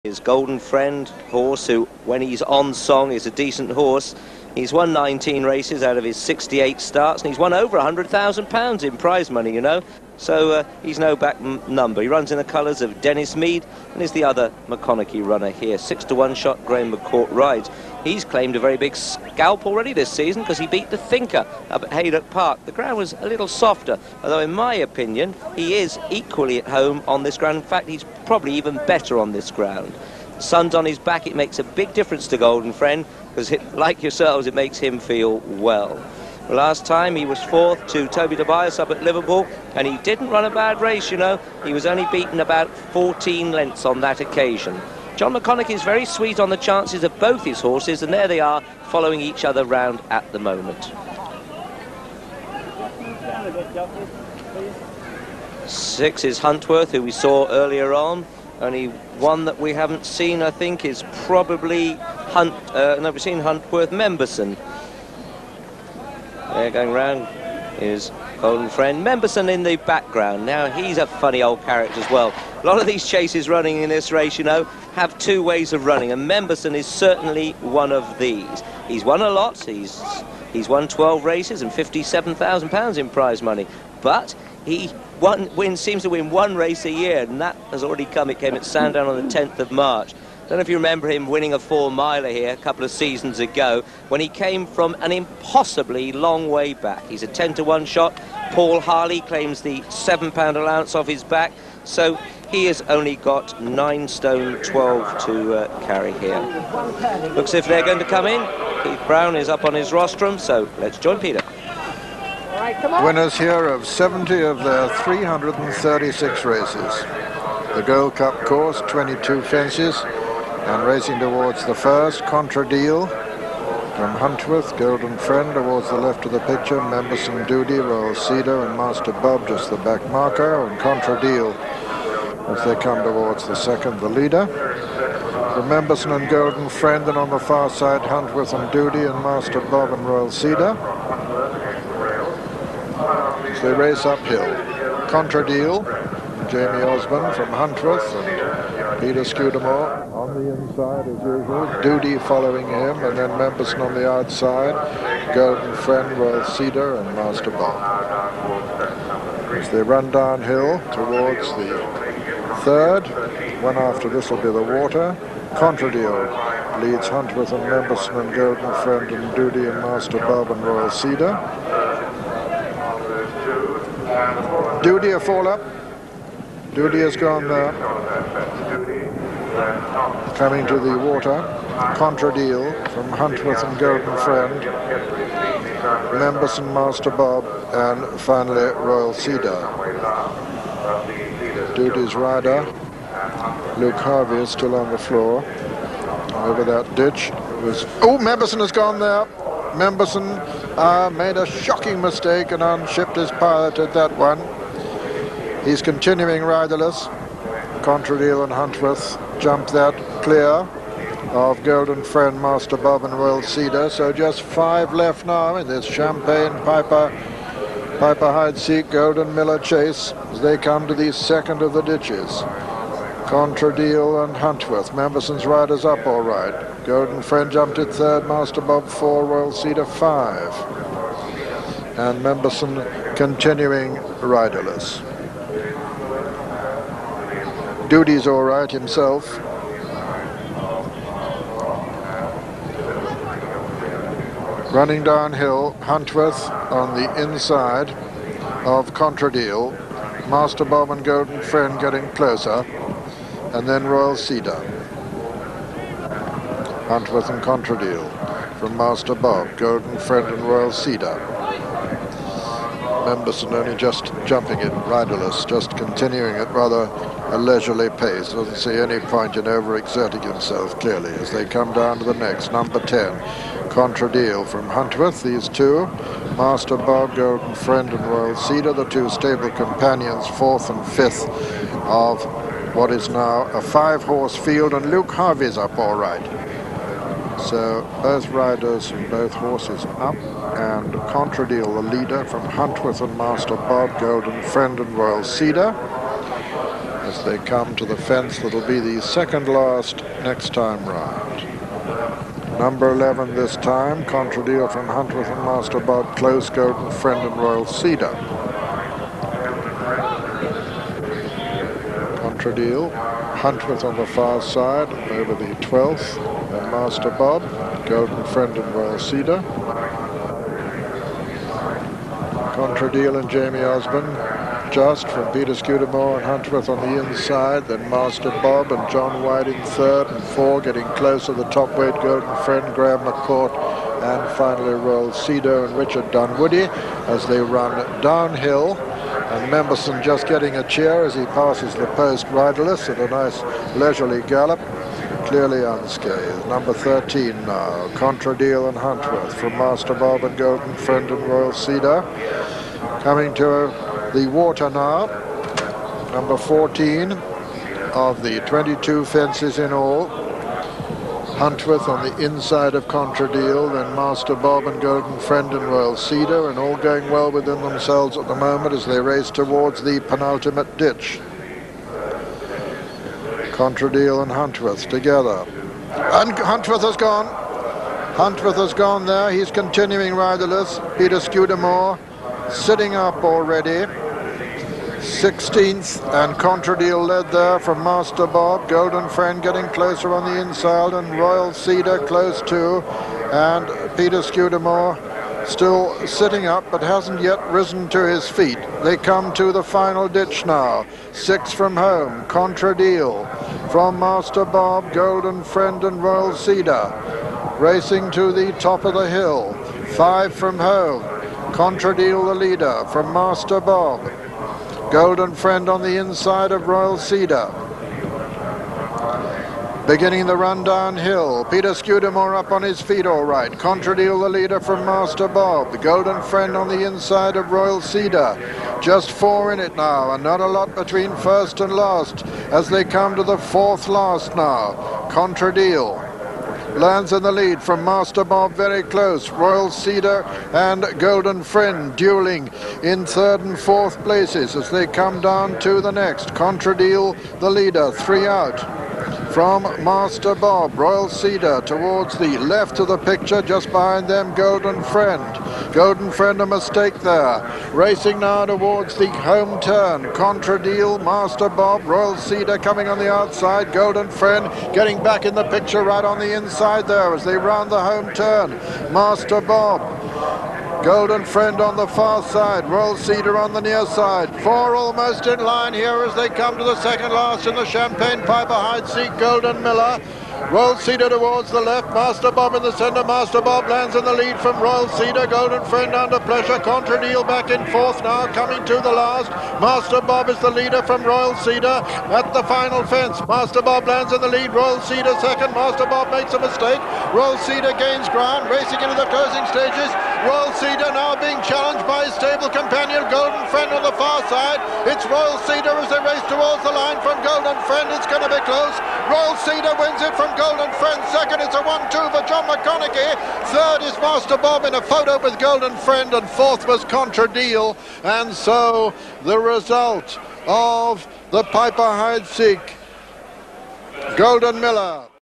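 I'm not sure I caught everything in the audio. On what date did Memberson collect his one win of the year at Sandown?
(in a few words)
10th of March.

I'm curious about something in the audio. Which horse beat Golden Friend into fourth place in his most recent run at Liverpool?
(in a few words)
Toby Tobias.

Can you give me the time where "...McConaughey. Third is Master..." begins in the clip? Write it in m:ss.
8:32.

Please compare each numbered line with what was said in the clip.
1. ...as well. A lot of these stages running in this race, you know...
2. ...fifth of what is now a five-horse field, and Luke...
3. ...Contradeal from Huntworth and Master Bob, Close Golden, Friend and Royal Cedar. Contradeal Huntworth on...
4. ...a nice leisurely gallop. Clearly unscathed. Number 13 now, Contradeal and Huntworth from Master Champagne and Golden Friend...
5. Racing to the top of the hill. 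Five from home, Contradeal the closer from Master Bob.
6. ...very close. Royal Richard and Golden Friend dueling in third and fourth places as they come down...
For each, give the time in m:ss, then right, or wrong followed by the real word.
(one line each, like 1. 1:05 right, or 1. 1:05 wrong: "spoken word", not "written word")
1. 1:12 wrong: "chases", not "stages"
2. 4:40 right
3. 5:04 right
4. 5:42 wrong: "Bob", not "Champagne"
5. 6:47 wrong: "leader", not "closer"
6. 7:18 wrong: "Cedar", not "Richard".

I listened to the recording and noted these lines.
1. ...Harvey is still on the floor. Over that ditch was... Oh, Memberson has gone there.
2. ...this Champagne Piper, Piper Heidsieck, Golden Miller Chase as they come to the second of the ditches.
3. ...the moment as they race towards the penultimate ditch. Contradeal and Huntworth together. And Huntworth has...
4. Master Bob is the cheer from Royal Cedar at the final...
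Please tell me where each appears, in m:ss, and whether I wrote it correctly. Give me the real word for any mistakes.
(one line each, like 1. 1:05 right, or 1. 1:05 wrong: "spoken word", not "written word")
1. 3:13 right
2. 3:35 right
3. 6:08 right
4. 8:09 wrong: "leader", not "cheer".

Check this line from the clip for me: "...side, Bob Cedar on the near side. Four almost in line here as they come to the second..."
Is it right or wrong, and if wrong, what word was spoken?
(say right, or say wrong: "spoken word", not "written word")
wrong: "Royal", not "Bob".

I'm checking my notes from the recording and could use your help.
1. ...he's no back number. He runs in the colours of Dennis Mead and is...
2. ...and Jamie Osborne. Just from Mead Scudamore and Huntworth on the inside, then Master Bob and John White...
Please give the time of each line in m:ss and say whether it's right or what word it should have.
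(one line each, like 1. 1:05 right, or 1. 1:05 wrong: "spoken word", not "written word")
1. 0:10 right
2. 5:23 wrong: "Peter", not "Mead".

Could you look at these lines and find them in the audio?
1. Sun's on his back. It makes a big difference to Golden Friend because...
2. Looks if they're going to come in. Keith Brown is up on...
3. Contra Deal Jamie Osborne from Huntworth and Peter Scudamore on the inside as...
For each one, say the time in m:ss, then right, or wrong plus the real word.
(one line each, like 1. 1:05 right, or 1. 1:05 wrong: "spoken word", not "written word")
1. 0:30 right
2. 1:47 right
3. 2:25 right.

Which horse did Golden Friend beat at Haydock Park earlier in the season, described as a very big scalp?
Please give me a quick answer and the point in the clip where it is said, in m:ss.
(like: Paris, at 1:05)
The Thinker, at 0:20.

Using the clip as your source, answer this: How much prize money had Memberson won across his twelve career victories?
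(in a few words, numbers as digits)
£57,000.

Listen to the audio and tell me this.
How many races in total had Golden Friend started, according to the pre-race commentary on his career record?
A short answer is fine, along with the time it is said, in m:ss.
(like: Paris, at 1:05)
68, at 0:06.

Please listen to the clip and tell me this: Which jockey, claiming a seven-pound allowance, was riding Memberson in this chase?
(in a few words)
Paul Harley.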